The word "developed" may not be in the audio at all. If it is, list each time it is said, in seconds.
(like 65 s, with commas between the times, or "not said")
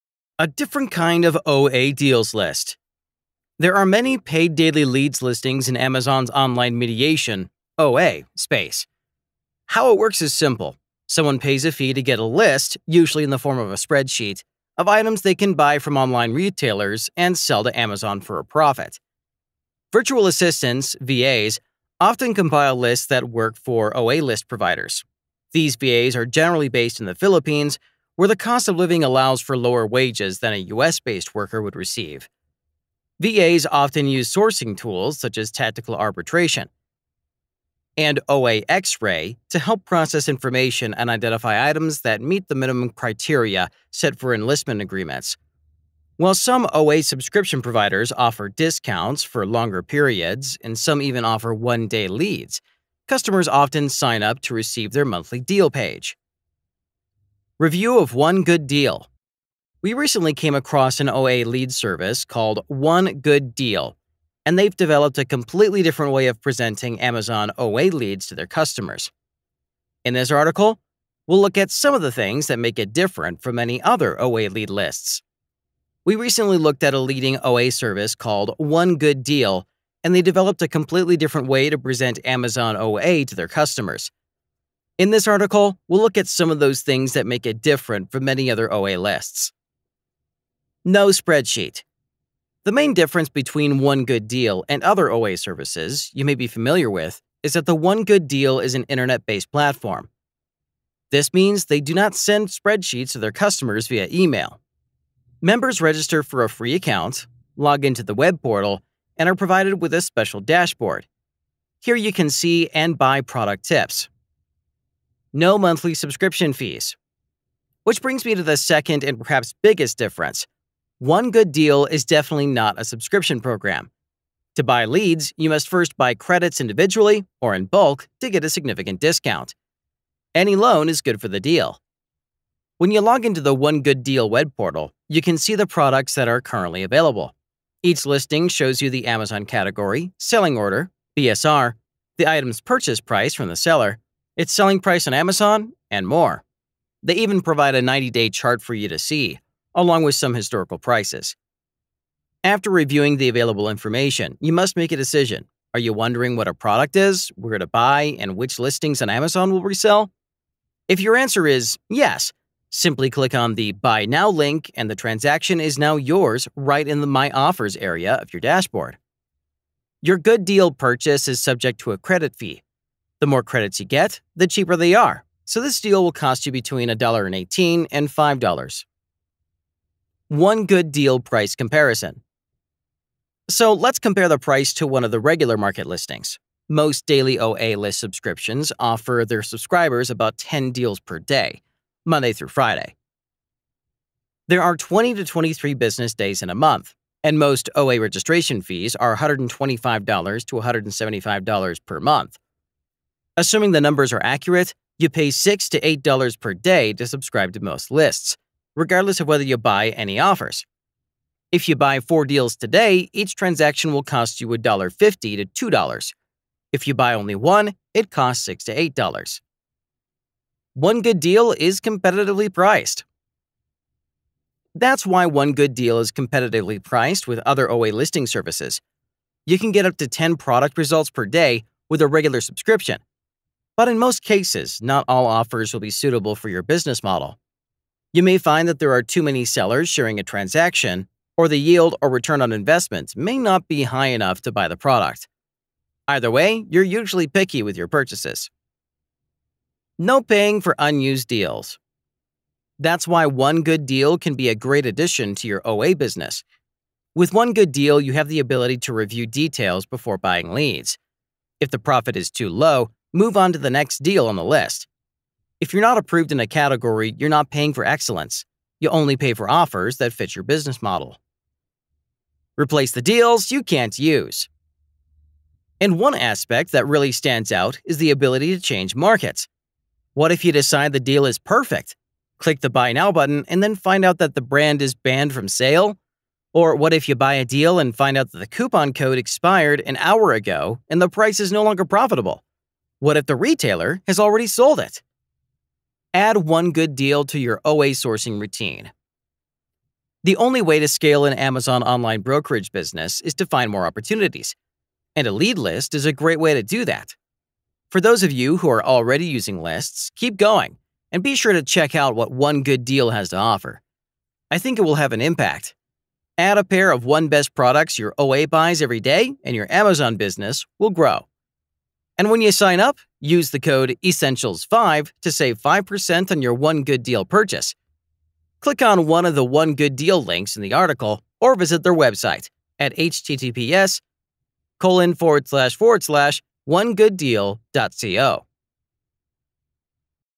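64 s, 80 s.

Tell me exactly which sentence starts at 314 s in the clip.
I think it will have an impact.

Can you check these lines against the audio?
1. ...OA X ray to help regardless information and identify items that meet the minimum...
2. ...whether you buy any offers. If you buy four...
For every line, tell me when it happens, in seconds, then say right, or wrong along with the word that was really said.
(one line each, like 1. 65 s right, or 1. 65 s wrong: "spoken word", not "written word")
1. 38 s wrong: "process", not "regardless"
2. 209 s right.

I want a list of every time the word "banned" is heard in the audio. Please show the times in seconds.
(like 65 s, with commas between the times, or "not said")
284 s.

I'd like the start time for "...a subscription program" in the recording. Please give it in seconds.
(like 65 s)
122 s.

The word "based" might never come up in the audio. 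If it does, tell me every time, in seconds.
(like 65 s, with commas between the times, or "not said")
26 s, 30 s, 99 s.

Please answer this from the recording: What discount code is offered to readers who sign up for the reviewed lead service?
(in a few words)
ESSENTIALS5.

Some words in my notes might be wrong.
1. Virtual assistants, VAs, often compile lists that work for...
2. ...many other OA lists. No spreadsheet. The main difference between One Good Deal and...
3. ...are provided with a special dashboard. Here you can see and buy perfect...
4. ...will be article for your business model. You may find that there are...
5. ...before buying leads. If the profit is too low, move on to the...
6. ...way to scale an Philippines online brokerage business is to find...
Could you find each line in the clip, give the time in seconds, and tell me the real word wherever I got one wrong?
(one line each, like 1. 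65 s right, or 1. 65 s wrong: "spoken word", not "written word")
1. 19 s right
2. 88 s right
3. 109 s wrong: "product", not "perfect"
4. 235 s wrong: "suitable", not "article"
5. 259 s right
6. 300 s wrong: "Amazon", not "Philippines".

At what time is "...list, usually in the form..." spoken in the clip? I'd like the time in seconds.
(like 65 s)
12 s.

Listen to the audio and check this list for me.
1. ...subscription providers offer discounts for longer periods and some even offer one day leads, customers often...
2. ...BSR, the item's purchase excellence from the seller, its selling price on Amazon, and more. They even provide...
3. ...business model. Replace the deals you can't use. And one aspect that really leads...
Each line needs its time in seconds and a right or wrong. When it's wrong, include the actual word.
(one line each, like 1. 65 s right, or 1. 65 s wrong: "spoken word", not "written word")
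1. 47 s right
2. 141 s wrong: "price", not "excellence"
3. 270 s wrong: "stands", not "leads".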